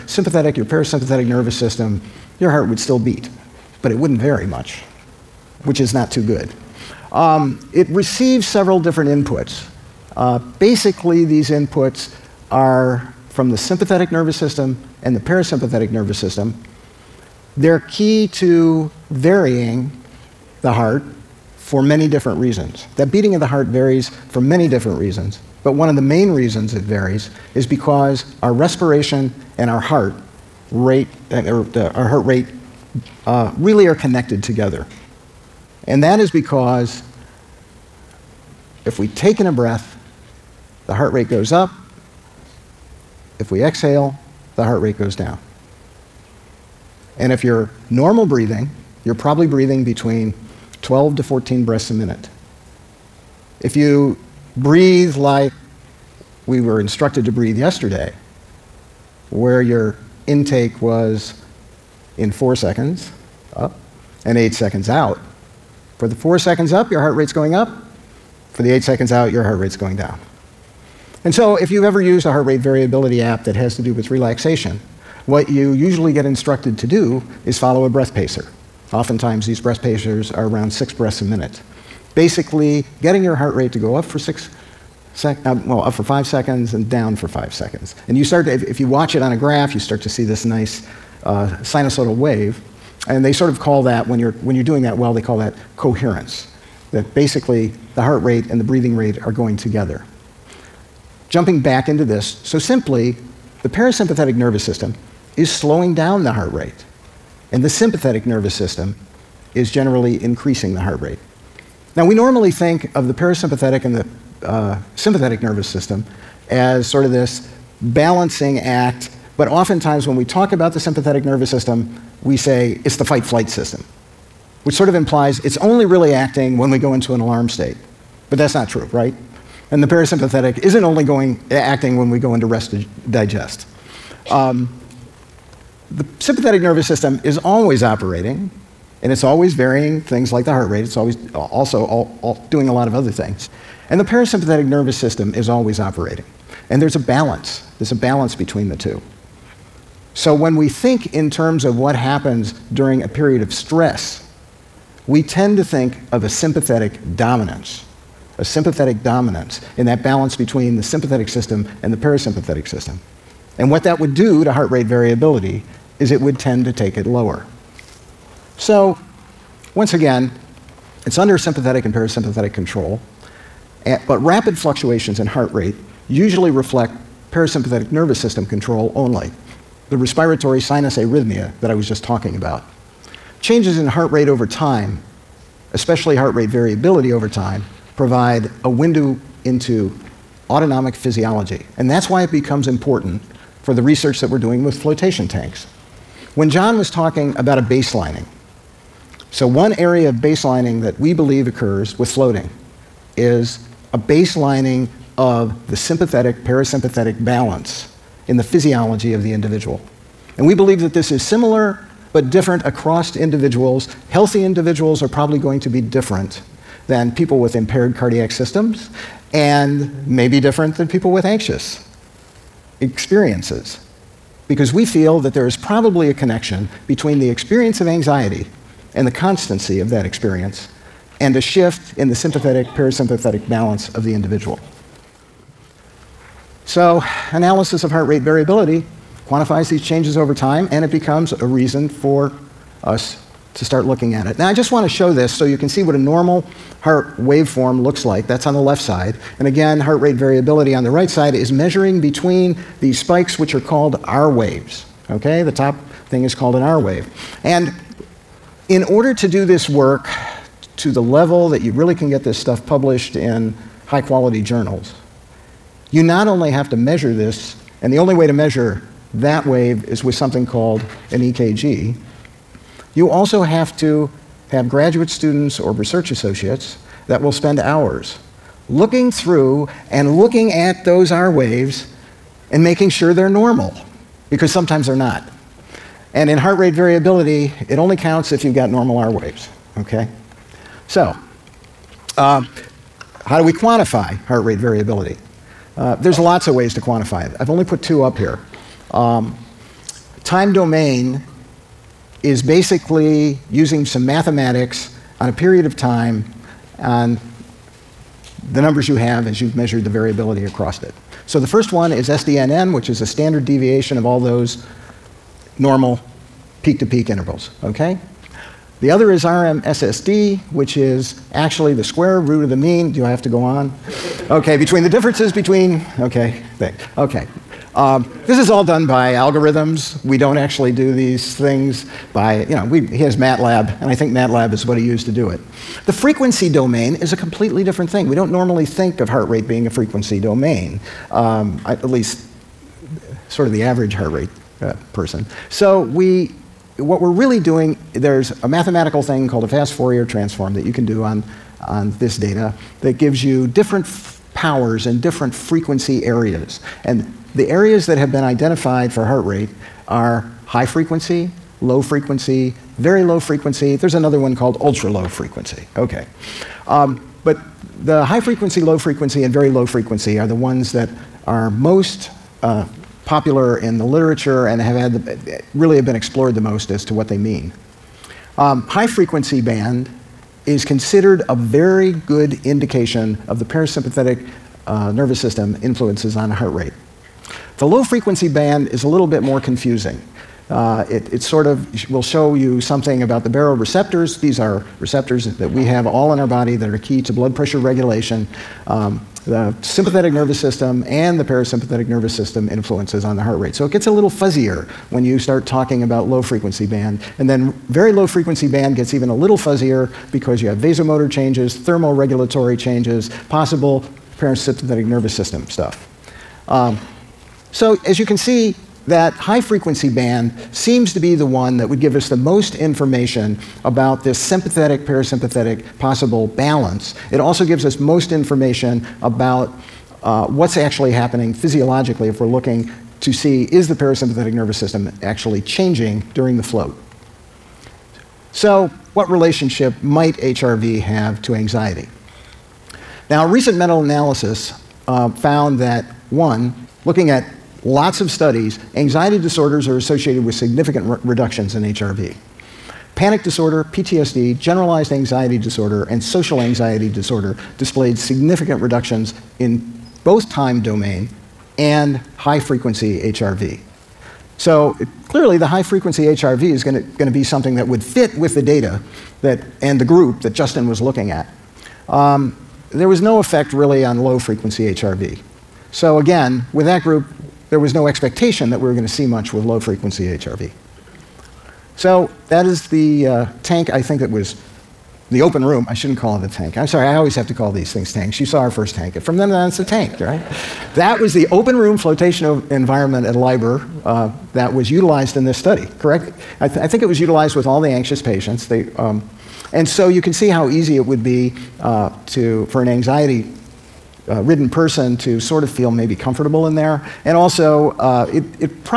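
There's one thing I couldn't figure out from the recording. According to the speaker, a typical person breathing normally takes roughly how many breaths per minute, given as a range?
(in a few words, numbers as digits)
12 to 14.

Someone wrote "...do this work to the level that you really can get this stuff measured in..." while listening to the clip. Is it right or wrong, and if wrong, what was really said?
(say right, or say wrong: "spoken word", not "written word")
wrong: "published", not "measured".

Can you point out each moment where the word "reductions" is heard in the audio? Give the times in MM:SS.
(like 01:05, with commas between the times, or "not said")
07:31, 07:38.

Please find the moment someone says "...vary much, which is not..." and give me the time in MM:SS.
00:04.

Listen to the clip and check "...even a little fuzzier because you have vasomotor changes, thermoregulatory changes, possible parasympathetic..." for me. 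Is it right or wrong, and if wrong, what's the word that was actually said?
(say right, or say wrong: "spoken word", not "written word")
right.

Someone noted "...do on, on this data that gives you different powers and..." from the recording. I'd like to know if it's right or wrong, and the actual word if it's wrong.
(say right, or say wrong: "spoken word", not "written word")
right.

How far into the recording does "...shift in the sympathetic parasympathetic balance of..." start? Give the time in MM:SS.
03:51.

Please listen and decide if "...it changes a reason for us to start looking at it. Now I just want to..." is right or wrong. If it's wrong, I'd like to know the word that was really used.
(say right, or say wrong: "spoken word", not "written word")
wrong: "becomes", not "changes".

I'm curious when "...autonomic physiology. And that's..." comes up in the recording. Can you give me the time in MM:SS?
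03:10.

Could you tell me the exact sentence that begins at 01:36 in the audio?
That basically the heart rate and the breathing rate are going together jumping back into this.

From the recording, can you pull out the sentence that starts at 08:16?
I, th I, think it was utilized with all the anxious patients.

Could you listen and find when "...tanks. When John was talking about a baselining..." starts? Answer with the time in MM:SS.
03:15.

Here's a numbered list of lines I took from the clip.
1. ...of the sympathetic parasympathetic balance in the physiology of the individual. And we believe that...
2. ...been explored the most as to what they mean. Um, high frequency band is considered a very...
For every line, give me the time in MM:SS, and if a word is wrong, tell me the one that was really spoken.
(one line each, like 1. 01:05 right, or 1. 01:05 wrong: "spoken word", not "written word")
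1. 03:25 right
2. 06:15 right.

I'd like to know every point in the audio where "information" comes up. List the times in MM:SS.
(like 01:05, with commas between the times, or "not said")
07:02, 07:08.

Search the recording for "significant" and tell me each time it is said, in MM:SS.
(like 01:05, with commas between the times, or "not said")
07:30, 07:37.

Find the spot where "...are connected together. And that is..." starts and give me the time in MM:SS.
00:33.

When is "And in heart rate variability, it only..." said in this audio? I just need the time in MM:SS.
04:46.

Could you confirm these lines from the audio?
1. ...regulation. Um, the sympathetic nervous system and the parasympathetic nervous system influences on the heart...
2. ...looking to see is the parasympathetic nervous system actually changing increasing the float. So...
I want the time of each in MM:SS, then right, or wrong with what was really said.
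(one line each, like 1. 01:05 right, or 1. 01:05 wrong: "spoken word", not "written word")
1. 06:37 right
2. 07:12 wrong: "during", not "increasing".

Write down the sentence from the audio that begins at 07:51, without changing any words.
Um, there was no effect really on low frequency HRV.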